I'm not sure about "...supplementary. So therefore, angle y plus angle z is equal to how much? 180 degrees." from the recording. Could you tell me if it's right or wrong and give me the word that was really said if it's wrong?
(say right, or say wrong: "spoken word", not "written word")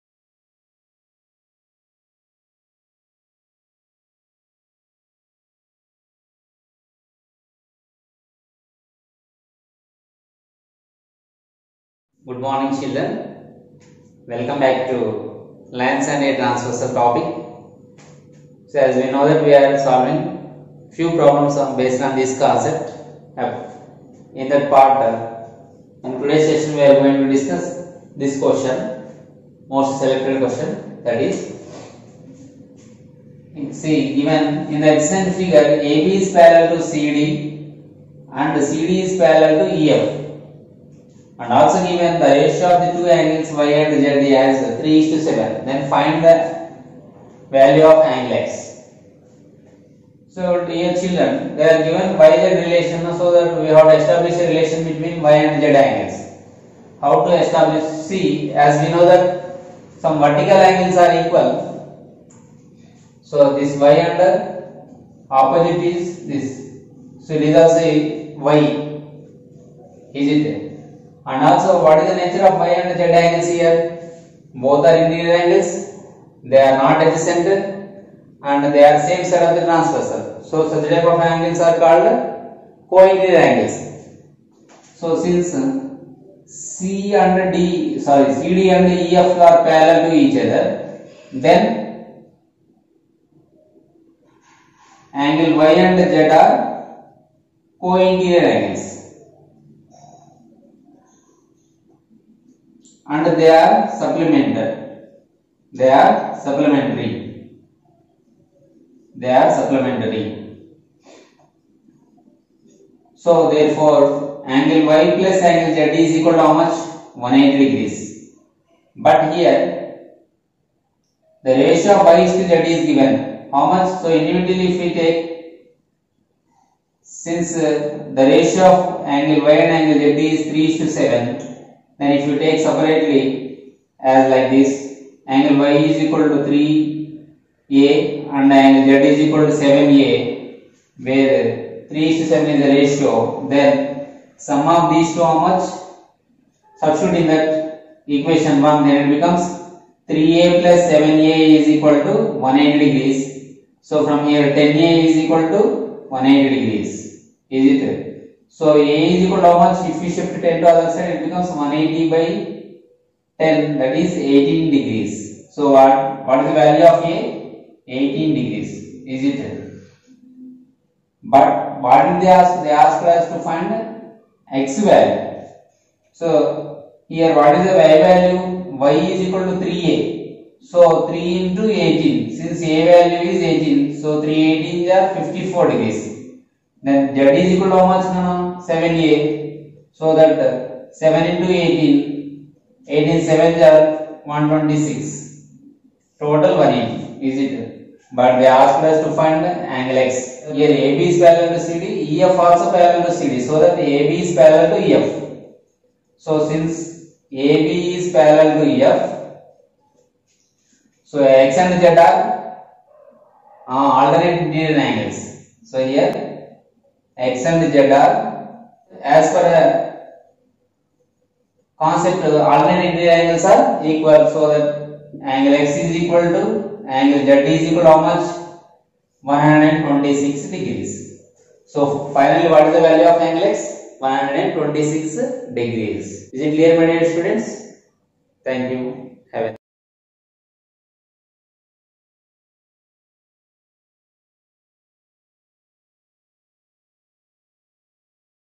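right.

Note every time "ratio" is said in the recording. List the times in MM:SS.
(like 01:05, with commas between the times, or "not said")
00:42, 02:01, 02:08, 02:22.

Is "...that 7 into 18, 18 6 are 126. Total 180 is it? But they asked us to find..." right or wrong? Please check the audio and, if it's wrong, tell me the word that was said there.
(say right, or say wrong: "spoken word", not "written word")
wrong: "7", not "6".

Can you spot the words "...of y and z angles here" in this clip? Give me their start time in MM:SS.
01:12.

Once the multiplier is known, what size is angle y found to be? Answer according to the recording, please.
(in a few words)
54 degrees.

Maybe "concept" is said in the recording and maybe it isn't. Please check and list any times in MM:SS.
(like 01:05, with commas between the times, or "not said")
00:22, 03:41.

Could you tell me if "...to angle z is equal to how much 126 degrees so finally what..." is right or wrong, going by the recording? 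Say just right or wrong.
right.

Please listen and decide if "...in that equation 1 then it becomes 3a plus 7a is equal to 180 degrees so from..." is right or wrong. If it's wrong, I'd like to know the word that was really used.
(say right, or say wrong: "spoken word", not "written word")
right.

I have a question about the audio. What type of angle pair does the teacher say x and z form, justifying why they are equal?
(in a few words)
alternate angles.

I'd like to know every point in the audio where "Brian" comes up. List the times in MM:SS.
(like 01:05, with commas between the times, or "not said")
not said.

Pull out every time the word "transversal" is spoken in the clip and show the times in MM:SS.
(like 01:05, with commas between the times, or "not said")
00:16, 01:19.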